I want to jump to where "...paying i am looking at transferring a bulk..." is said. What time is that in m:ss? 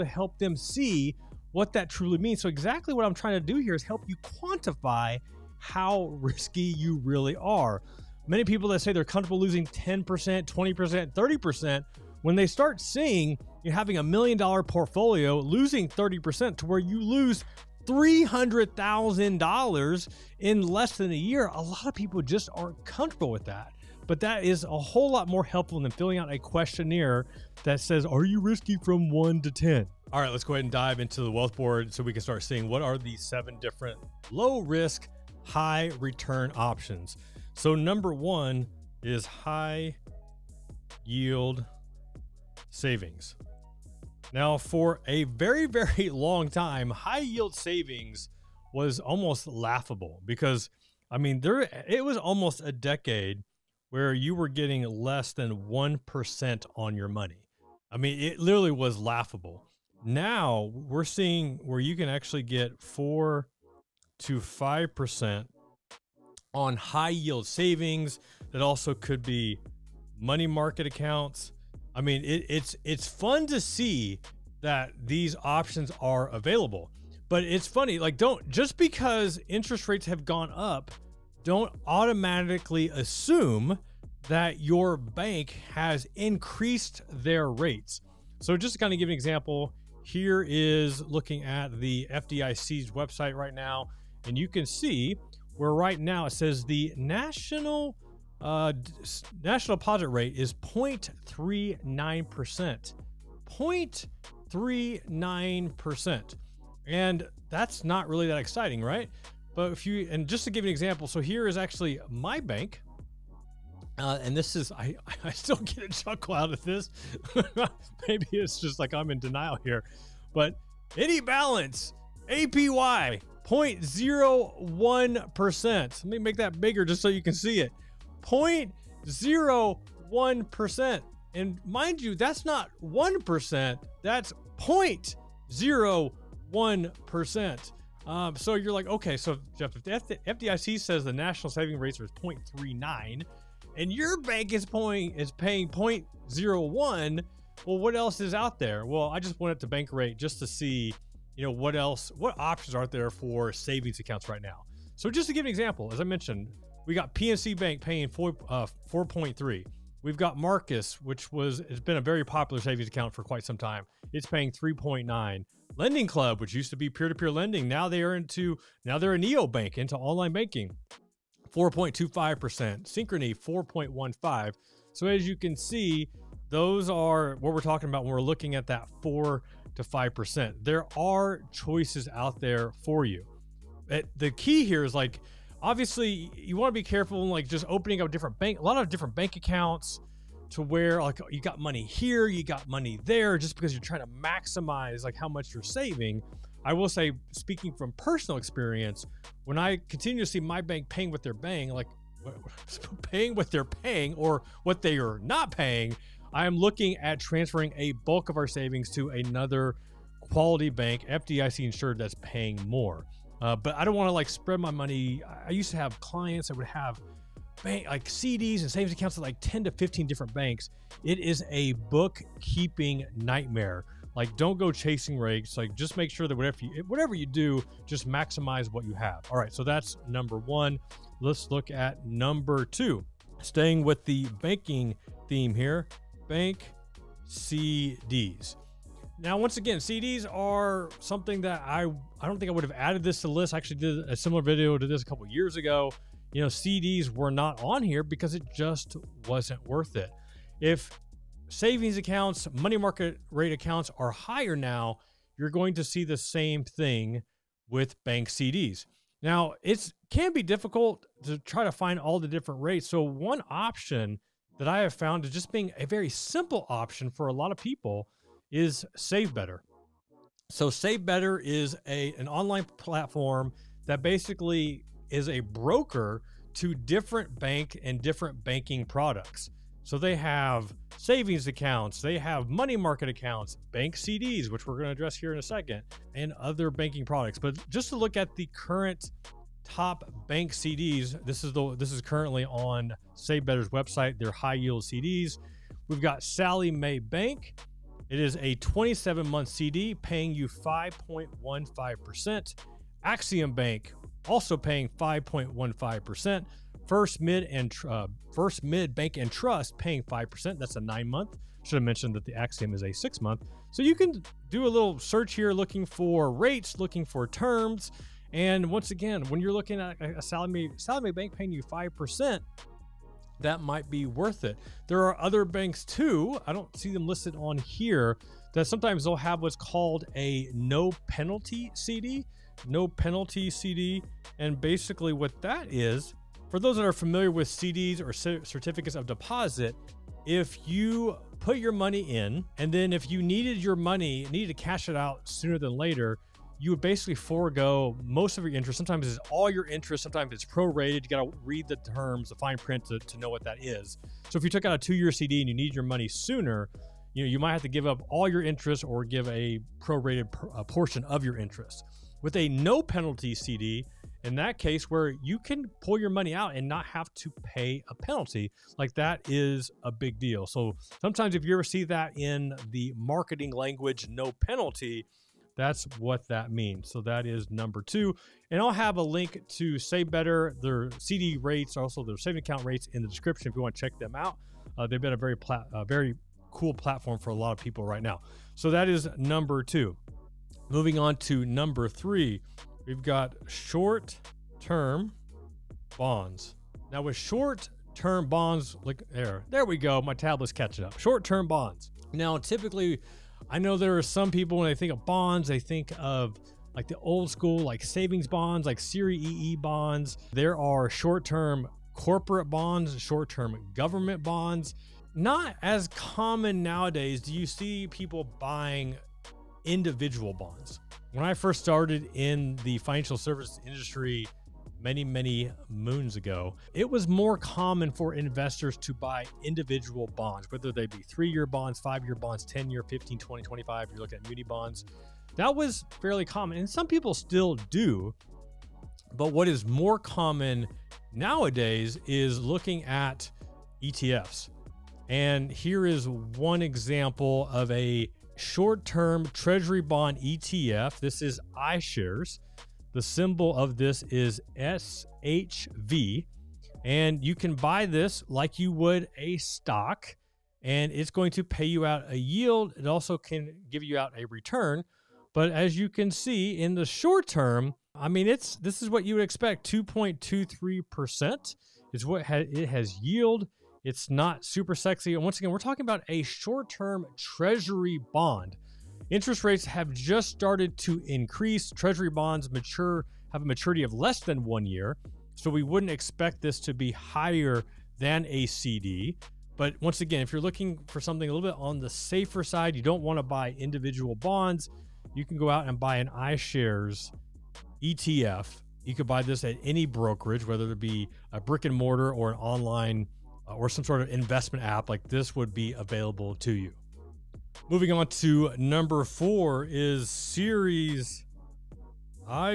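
3:25.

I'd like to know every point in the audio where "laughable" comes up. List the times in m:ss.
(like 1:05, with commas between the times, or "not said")
0:49, 0:58.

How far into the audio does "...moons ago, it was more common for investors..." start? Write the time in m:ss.
7:05.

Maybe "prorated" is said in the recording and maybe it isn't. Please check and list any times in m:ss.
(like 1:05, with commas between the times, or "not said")
5:50, 5:59.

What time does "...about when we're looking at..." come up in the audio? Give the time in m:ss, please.
2:57.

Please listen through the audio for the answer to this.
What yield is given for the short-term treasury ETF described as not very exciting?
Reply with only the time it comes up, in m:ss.
7:49.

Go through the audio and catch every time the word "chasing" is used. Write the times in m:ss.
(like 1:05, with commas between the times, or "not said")
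3:44.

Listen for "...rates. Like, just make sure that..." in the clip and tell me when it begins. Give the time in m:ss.
3:45.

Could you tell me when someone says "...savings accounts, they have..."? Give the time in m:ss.
4:40.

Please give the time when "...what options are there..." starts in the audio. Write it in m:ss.
2:32.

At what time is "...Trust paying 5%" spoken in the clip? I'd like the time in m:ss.
5:09.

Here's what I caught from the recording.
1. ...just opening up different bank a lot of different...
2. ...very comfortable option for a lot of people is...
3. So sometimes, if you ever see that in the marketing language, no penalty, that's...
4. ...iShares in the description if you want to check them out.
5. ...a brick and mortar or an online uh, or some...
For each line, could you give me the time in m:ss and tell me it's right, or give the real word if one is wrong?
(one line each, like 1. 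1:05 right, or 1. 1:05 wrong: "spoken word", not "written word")
1. 3:07 right
2. 4:25 wrong: "simple", not "comfortable"
3. 6:10 right
4. 6:22 wrong: "rates", not "iShares"
5. 8:21 right.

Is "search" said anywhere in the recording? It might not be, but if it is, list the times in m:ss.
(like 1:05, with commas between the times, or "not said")
5:14.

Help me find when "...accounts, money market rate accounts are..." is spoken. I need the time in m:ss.
4:11.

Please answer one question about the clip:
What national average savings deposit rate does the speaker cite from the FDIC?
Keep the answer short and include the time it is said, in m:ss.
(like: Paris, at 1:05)
0.39%, at 1:40.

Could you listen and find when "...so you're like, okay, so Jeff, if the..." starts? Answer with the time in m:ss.
2:18.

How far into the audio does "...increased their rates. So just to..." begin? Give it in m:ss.
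1:26.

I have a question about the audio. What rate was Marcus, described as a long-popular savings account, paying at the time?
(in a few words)
3.9%.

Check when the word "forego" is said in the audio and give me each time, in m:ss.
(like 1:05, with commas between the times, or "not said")
5:47.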